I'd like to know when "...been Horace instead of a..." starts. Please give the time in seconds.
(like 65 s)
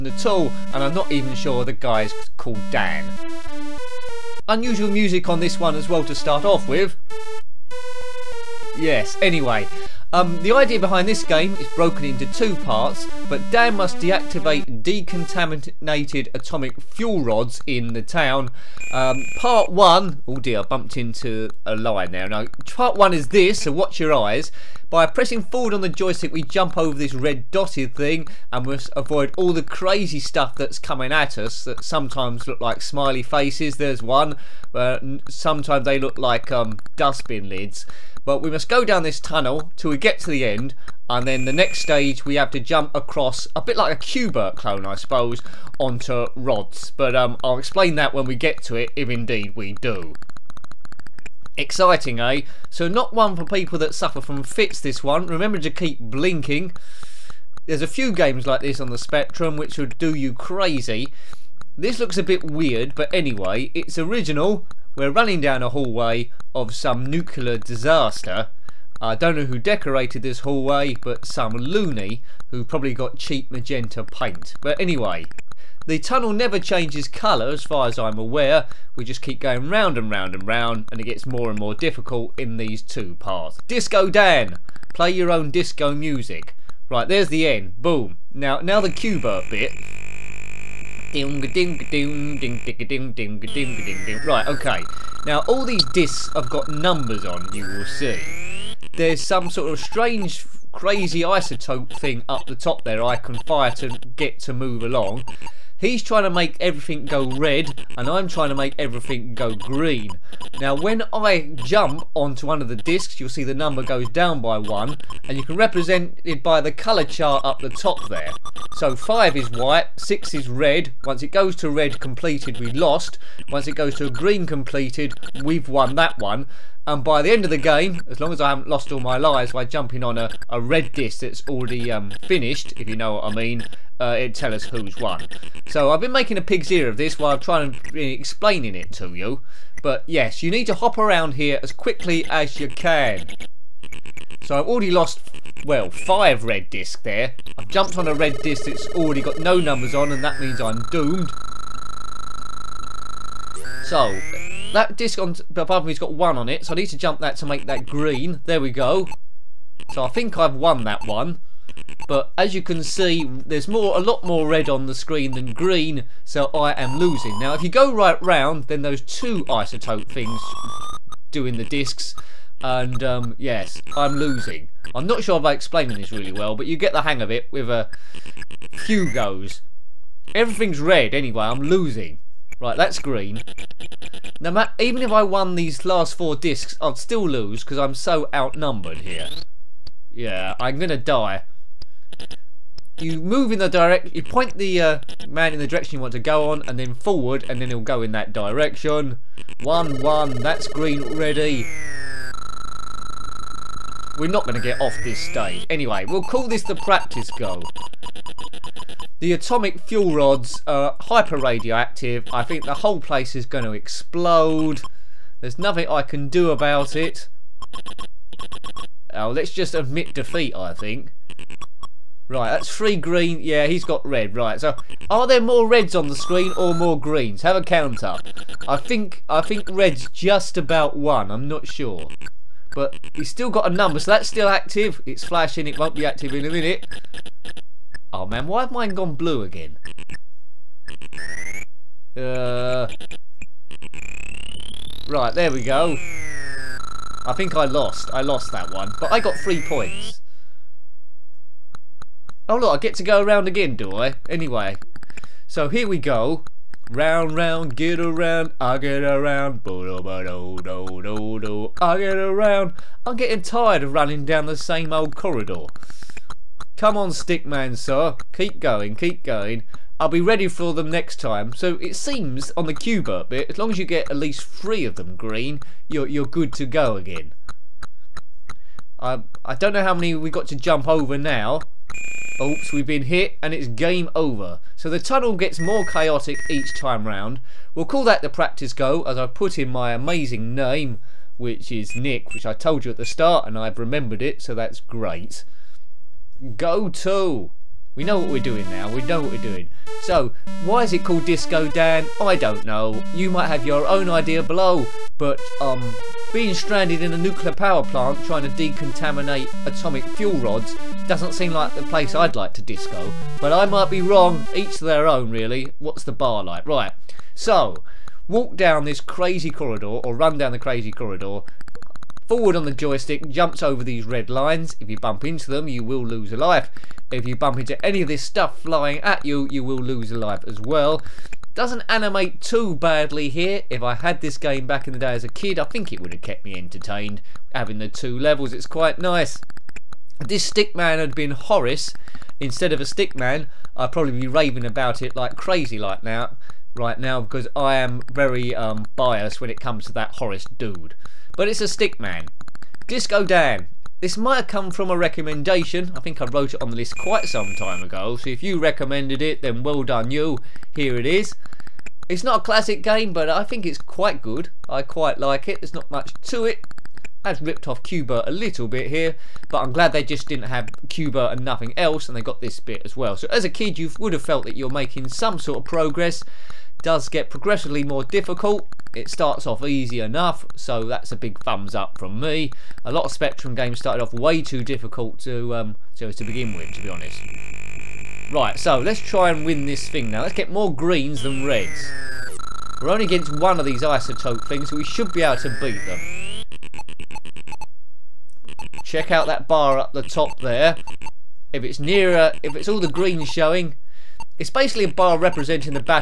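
341 s.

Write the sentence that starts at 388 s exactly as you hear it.
Right, so let's try and win this thing now.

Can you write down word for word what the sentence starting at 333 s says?
If I had this game back in the day as a kid, I think it would have kept me entertained.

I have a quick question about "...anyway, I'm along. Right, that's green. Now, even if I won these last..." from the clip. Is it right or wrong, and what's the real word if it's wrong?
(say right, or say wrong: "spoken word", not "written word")
wrong: "losing", not "along".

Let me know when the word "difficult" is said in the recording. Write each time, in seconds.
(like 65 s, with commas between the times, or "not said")
81 s, 378 s, 384 s.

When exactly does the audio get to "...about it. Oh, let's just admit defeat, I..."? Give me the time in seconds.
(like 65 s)
216 s.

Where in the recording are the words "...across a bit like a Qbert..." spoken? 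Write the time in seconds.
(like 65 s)
42 s.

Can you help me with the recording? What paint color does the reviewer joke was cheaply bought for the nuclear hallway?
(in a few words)
magenta.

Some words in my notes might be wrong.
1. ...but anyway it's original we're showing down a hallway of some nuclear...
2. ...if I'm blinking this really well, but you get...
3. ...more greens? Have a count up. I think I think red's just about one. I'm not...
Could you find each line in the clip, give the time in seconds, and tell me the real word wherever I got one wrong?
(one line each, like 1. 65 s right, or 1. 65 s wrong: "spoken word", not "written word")
1. 62 s wrong: "running", not "showing"
2. 175 s wrong: "explaining", not "blinking"
3. 226 s right.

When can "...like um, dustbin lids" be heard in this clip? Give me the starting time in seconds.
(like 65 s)
36 s.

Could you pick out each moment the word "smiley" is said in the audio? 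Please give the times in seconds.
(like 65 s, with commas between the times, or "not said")
32 s.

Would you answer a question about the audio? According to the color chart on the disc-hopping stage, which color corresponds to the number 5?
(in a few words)
white.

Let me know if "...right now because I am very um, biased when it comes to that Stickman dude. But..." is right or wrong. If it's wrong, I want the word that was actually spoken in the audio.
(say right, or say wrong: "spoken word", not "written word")
wrong: "Horace", not "Stickman".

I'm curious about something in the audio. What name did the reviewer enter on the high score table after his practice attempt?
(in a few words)
Nick.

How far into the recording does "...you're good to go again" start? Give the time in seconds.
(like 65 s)
276 s.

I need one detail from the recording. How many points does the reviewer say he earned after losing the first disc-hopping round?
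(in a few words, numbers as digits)
3.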